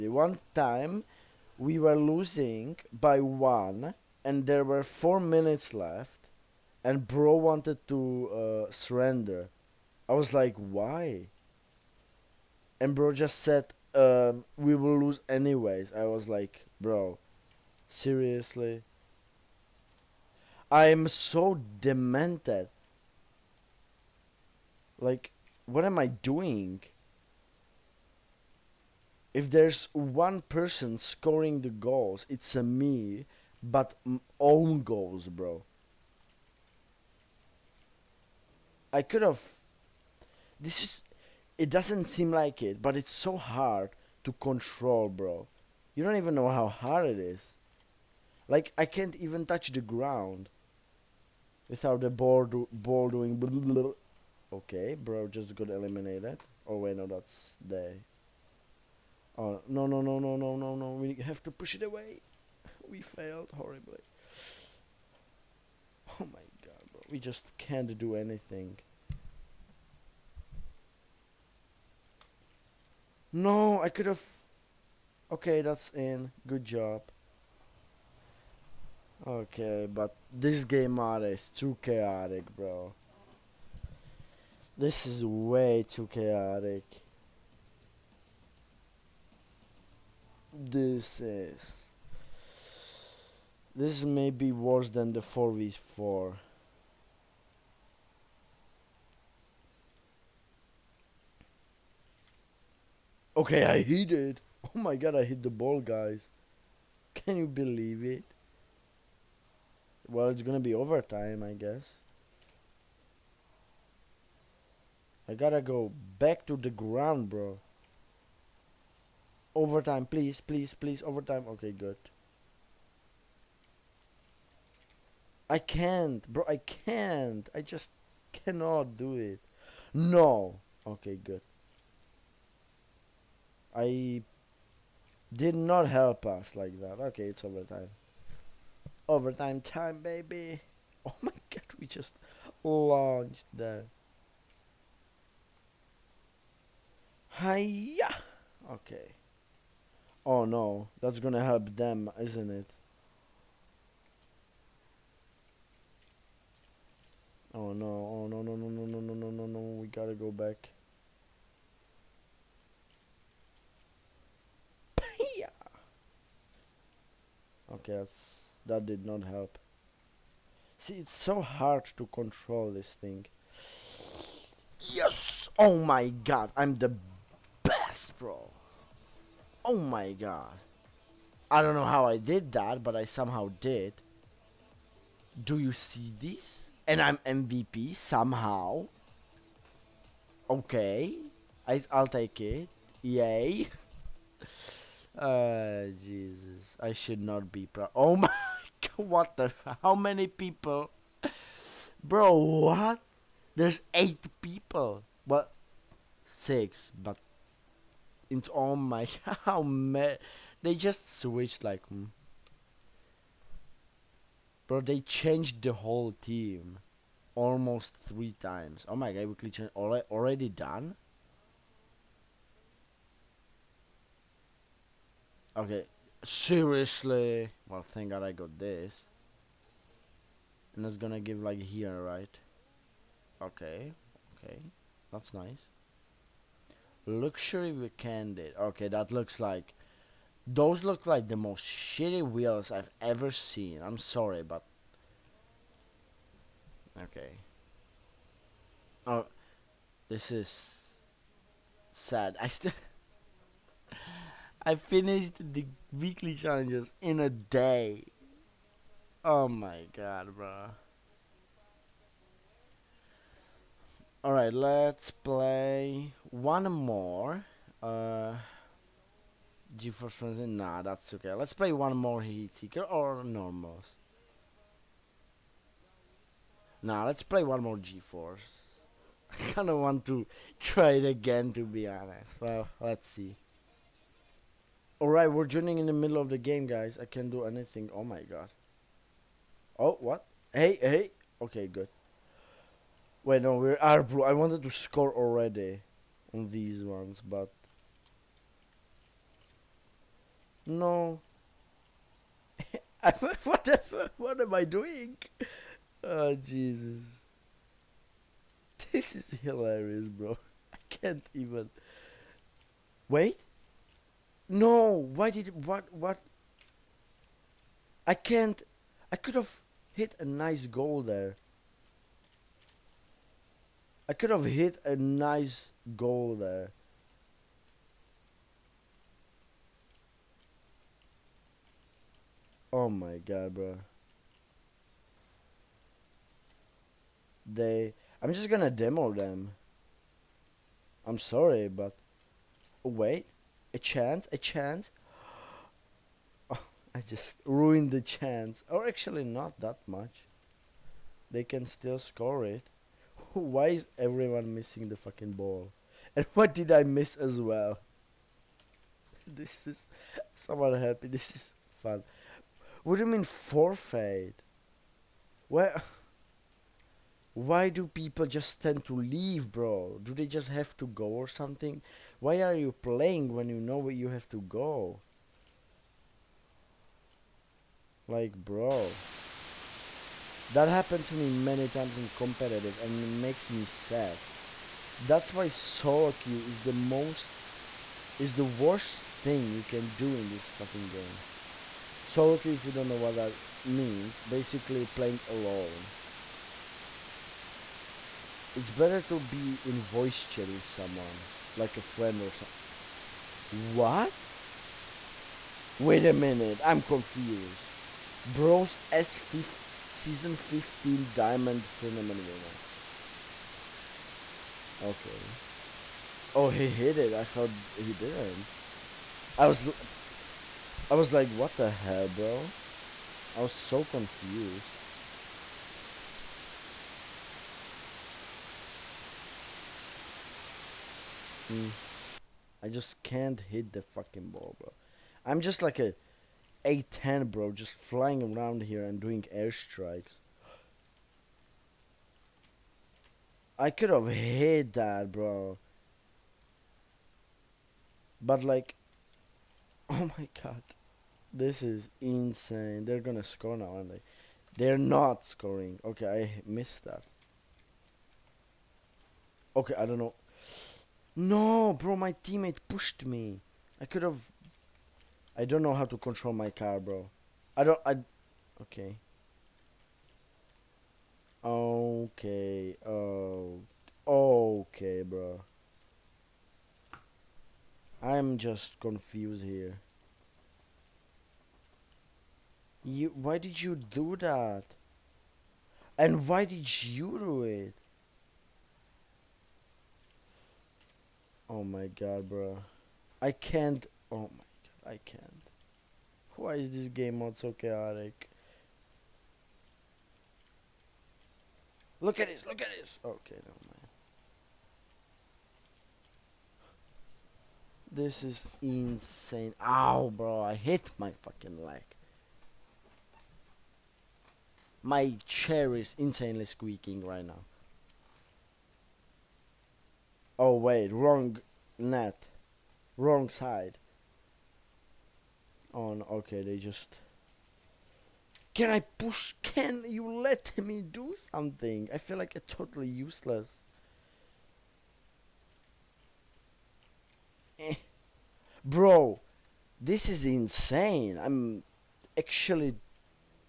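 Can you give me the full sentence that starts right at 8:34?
My chair is insanely squeaking right now.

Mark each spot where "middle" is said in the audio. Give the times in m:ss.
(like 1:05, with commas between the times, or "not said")
4:45.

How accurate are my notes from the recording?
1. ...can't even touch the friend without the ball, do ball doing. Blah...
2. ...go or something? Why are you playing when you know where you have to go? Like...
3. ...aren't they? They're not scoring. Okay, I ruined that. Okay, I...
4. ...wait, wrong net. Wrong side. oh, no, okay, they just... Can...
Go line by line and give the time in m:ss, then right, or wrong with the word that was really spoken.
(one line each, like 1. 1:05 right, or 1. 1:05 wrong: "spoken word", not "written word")
1. 0:48 wrong: "ground", not "friend"
2. 6:11 right
3. 7:33 wrong: "missed", not "ruined"
4. 8:40 right.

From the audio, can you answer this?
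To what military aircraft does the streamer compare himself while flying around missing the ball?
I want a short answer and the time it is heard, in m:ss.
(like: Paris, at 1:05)
A10, at 7:16.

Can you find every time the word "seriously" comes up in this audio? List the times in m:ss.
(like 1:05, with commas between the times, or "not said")
0:17, 3:46.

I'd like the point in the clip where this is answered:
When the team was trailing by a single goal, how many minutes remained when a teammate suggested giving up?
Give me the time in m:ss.
0:04.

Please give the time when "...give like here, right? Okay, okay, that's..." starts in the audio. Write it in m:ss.
3:51.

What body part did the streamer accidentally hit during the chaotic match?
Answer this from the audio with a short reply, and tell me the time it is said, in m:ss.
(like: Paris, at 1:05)
Leg, at 8:31.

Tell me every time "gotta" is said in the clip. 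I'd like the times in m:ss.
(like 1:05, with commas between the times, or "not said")
1:55, 2:39.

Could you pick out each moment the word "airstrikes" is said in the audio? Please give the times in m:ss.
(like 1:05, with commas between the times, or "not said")
7:19.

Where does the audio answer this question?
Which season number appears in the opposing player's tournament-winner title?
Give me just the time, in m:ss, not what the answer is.
6:49.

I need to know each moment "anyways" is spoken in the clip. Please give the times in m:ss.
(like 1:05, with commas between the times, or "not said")
0:15.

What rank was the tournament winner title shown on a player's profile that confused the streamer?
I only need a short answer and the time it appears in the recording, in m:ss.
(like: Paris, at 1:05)
Diamond, at 6:51.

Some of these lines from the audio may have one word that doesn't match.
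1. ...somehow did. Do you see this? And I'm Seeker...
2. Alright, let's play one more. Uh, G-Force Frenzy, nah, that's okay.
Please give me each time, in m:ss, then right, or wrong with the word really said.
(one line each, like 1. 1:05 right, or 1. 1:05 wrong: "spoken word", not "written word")
1. 3:03 wrong: "MVP", not "Seeker"
2. 4:24 right.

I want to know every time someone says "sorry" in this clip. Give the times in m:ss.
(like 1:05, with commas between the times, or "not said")
4:03, 5:41.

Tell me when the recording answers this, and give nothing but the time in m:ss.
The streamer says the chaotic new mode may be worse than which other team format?
1:35.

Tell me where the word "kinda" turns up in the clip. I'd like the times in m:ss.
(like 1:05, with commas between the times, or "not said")
4:39.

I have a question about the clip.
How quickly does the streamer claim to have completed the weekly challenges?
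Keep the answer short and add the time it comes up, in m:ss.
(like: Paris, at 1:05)
In a day, at 4:16.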